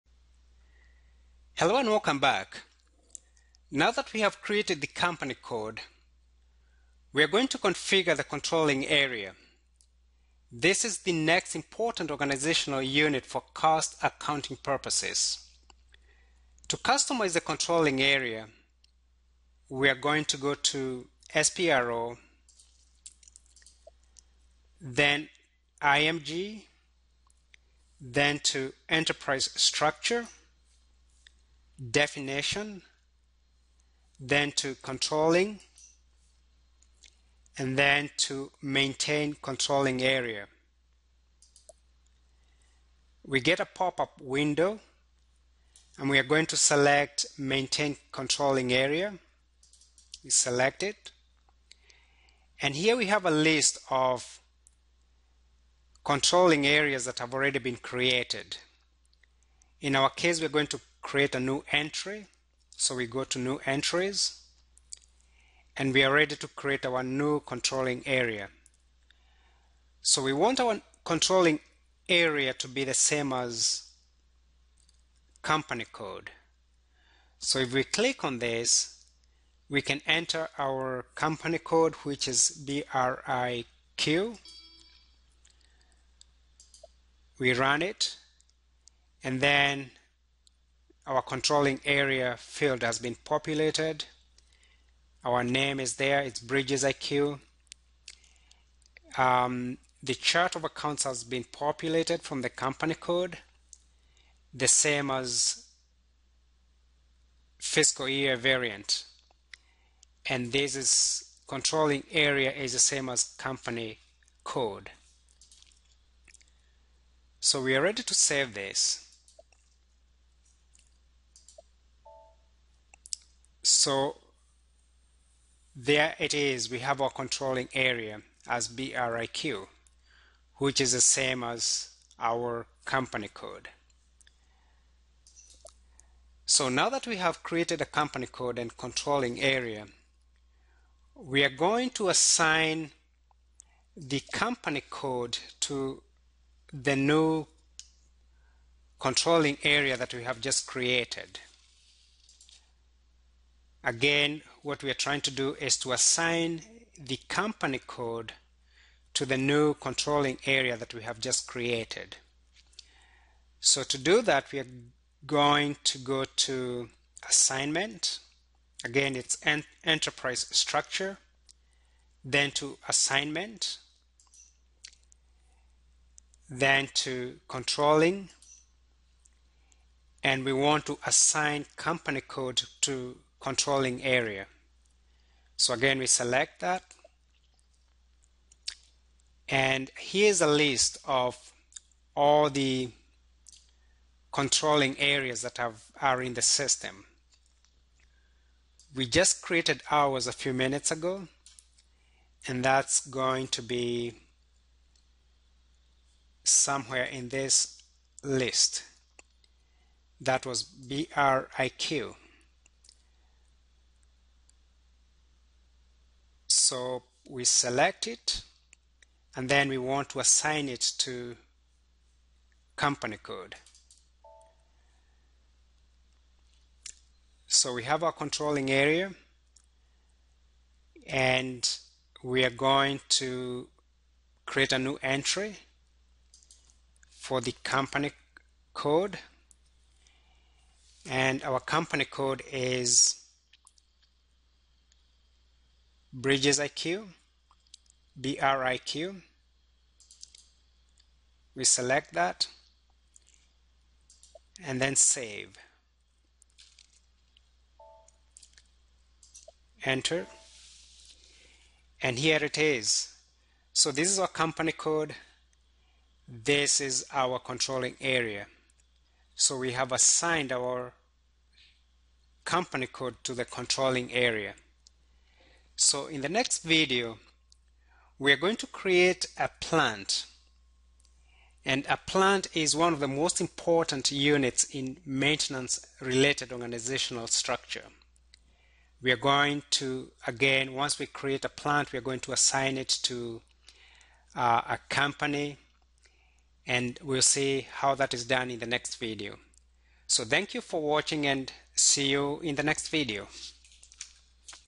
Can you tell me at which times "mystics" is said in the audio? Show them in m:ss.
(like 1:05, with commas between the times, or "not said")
not said.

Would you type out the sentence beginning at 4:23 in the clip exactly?
So this is our company code.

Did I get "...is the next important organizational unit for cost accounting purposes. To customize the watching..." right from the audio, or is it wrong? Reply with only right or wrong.
wrong.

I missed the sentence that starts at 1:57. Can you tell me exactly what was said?
So we are ready to save this.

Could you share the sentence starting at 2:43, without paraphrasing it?
So to do that, we are going to go to assignment.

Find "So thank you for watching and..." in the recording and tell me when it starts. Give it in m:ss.
5:00.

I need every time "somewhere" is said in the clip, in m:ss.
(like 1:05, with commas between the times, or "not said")
3:26.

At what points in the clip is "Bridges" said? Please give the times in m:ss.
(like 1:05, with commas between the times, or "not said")
1:36, 4:06.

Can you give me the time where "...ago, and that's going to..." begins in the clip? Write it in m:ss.
3:20.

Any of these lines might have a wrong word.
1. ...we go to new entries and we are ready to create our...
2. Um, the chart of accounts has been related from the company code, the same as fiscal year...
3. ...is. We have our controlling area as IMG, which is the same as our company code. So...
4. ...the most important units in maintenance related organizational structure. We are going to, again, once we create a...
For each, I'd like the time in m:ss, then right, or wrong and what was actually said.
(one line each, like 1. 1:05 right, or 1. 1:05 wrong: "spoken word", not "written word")
1. 1:02 right
2. 1:39 wrong: "populated", not "related"
3. 2:06 wrong: "BRIQ", not "IMG"
4. 4:42 right.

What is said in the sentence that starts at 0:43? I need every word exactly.
We get a pop-up window and we are going to select maintain controlling area.